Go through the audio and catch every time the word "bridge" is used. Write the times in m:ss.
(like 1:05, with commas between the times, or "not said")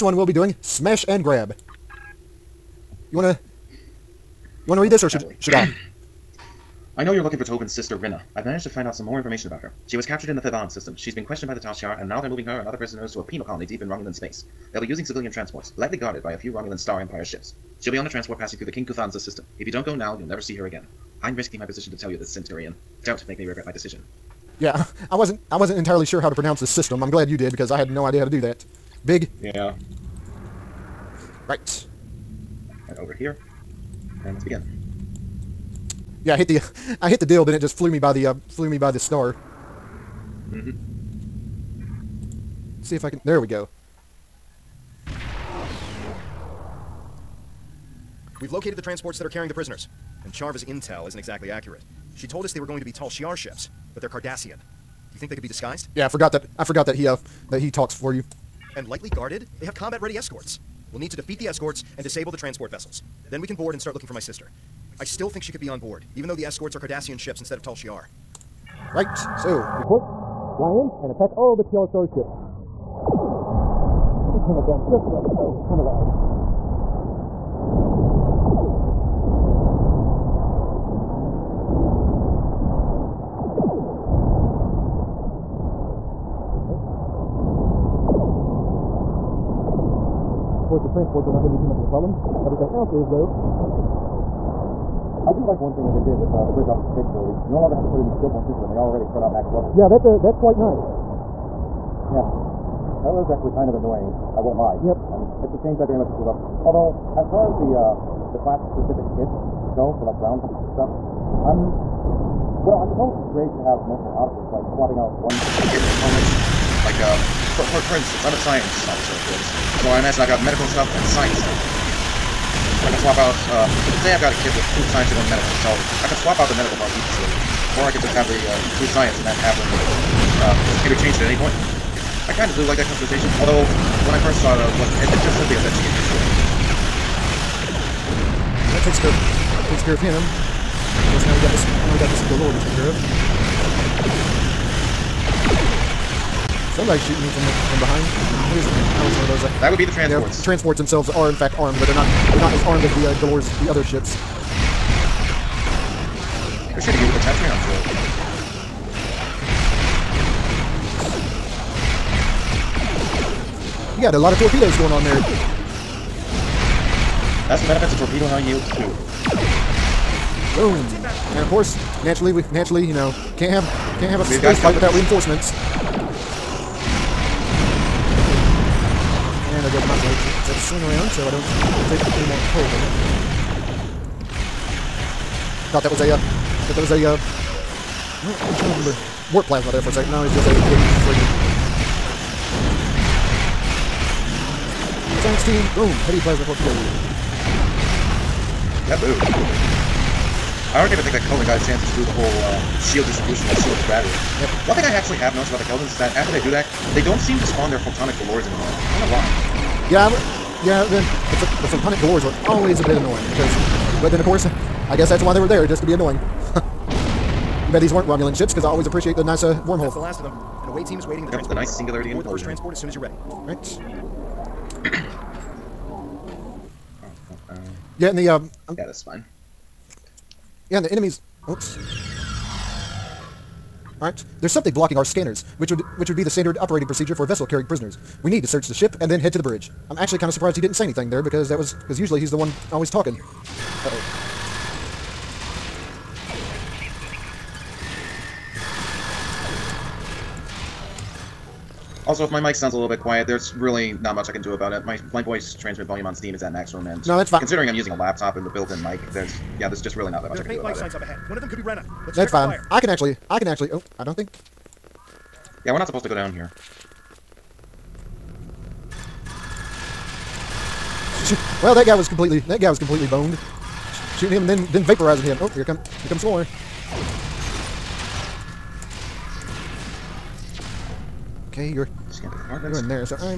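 1:36, 3:59.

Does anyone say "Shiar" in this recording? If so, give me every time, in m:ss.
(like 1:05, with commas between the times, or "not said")
0:11, 0:53, 1:07, 1:11.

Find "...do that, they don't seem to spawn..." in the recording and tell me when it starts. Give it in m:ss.
3:26.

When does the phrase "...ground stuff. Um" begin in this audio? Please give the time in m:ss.
1:50.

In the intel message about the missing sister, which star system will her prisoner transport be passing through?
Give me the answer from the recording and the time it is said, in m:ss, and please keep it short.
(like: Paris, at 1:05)
King Kuthanza, at 0:18.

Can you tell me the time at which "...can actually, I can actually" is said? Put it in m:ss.
4:22.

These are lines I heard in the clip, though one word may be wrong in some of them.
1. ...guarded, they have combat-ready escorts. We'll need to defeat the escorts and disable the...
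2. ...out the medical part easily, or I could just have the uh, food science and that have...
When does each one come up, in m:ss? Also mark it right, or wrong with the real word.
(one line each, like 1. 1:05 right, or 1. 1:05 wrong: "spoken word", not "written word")
1. 0:59 right
2. 2:06 right.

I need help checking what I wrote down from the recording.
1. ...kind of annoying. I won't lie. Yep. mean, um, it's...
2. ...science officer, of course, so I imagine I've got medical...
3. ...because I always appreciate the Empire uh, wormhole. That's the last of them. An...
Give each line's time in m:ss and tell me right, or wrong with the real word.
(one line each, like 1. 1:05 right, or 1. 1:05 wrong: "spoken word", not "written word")
1. 1:43 right
2. 1:58 right
3. 3:38 wrong: "NASA", not "Empire".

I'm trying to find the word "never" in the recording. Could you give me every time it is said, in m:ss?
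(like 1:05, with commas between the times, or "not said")
0:20.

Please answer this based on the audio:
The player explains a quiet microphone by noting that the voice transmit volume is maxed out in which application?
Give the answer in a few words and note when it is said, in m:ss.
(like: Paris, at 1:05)
Steam, at 4:16.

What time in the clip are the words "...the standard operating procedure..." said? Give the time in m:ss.
3:56.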